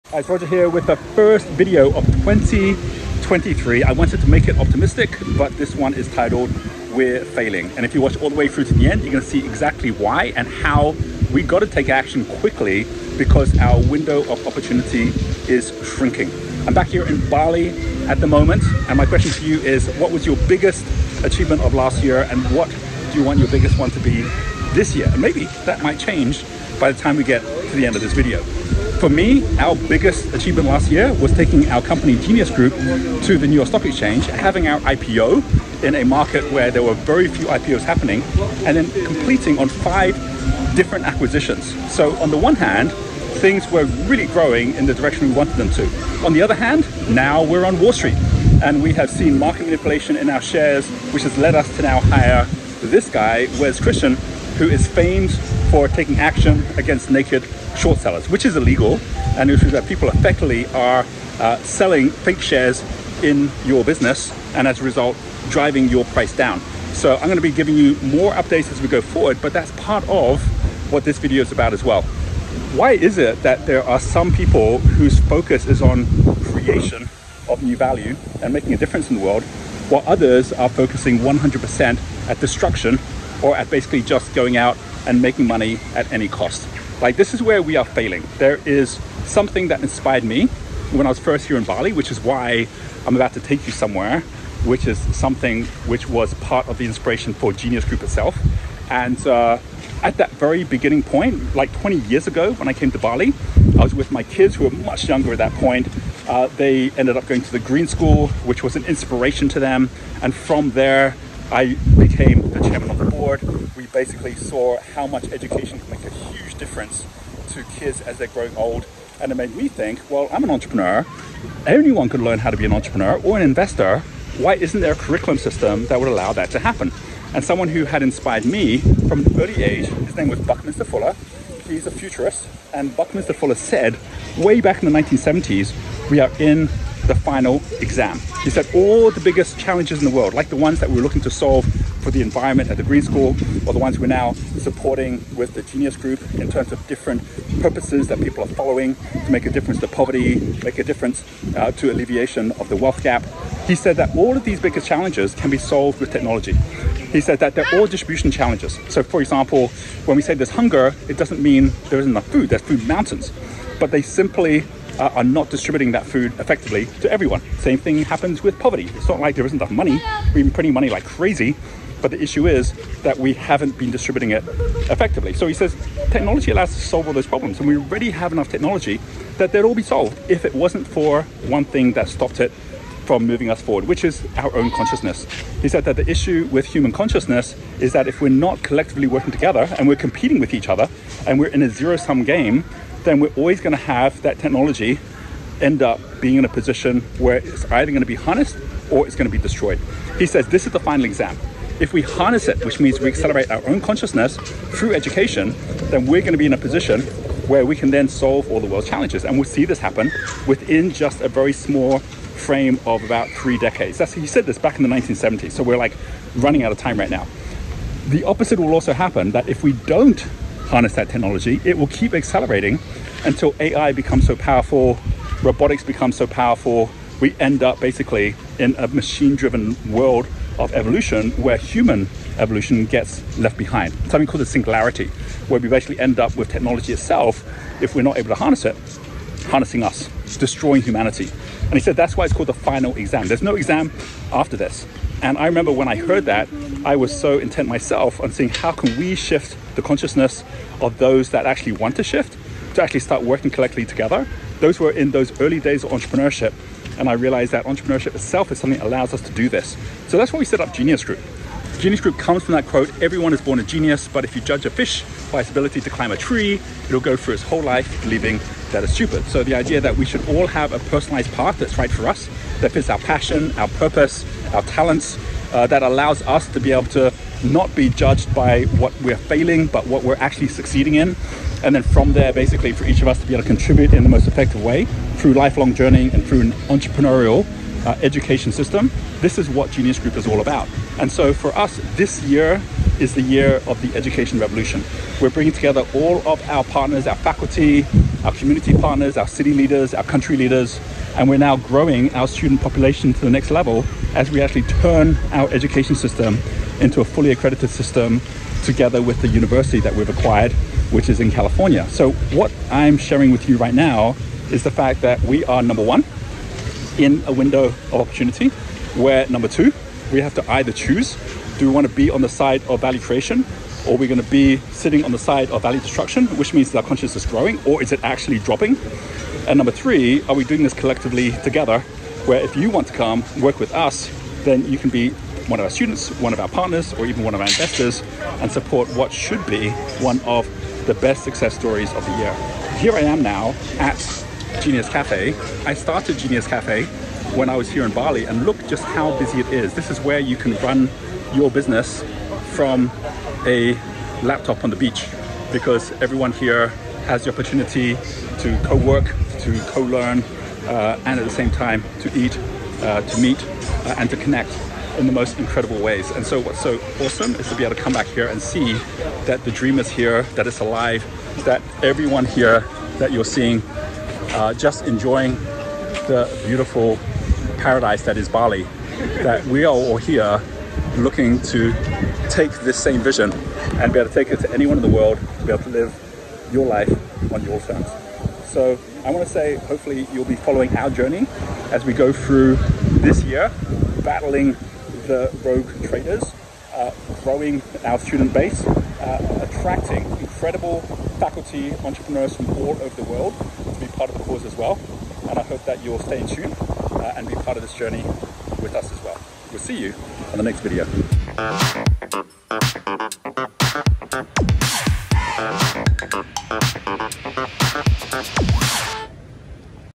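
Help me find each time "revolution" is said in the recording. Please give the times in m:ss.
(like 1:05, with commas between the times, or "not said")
4:54.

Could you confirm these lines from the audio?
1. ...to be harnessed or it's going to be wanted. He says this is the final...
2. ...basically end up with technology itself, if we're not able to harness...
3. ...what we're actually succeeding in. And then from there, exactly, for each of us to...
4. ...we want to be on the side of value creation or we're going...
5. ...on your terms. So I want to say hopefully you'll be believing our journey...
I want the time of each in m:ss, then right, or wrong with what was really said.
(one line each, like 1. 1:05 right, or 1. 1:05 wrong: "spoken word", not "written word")
1. 3:18 wrong: "destroyed", not "wanted"
2. 3:55 right
3. 4:39 wrong: "basically", not "exactly"
4. 5:21 right
5. 6:27 wrong: "following", not "believing".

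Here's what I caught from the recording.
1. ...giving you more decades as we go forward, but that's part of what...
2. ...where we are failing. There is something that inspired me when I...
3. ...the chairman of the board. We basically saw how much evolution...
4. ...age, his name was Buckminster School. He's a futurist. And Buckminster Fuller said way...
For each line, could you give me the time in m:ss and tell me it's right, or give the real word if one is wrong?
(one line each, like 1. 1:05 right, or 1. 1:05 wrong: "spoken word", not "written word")
1. 1:07 wrong: "updates", not "decades"
2. 1:27 right
3. 1:52 wrong: "education", not "evolution"
4. 2:09 wrong: "Fuller", not "School".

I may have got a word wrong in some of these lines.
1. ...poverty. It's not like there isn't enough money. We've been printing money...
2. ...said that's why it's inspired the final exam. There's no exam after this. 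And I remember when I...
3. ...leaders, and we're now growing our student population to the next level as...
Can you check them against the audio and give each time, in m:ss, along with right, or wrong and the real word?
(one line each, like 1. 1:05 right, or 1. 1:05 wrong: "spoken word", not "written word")
1. 2:48 right
2. 4:01 wrong: "called", not "inspired"
3. 5:00 right.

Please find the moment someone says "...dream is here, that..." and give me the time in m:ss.
6:09.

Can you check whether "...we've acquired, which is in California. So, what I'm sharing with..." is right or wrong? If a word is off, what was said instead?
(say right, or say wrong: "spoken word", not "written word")
right.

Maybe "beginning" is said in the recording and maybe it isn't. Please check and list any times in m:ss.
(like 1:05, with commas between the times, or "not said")
1:40.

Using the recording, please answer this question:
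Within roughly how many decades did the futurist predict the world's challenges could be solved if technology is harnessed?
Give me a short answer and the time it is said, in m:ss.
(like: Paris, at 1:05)
3, at 3:33.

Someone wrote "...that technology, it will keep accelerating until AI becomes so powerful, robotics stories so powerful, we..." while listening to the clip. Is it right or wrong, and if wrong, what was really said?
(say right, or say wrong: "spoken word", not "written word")
wrong: "becomes", not "stories".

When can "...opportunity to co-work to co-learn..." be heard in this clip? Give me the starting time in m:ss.
5:57.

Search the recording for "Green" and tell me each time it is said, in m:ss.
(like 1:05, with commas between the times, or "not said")
1:47, 2:22.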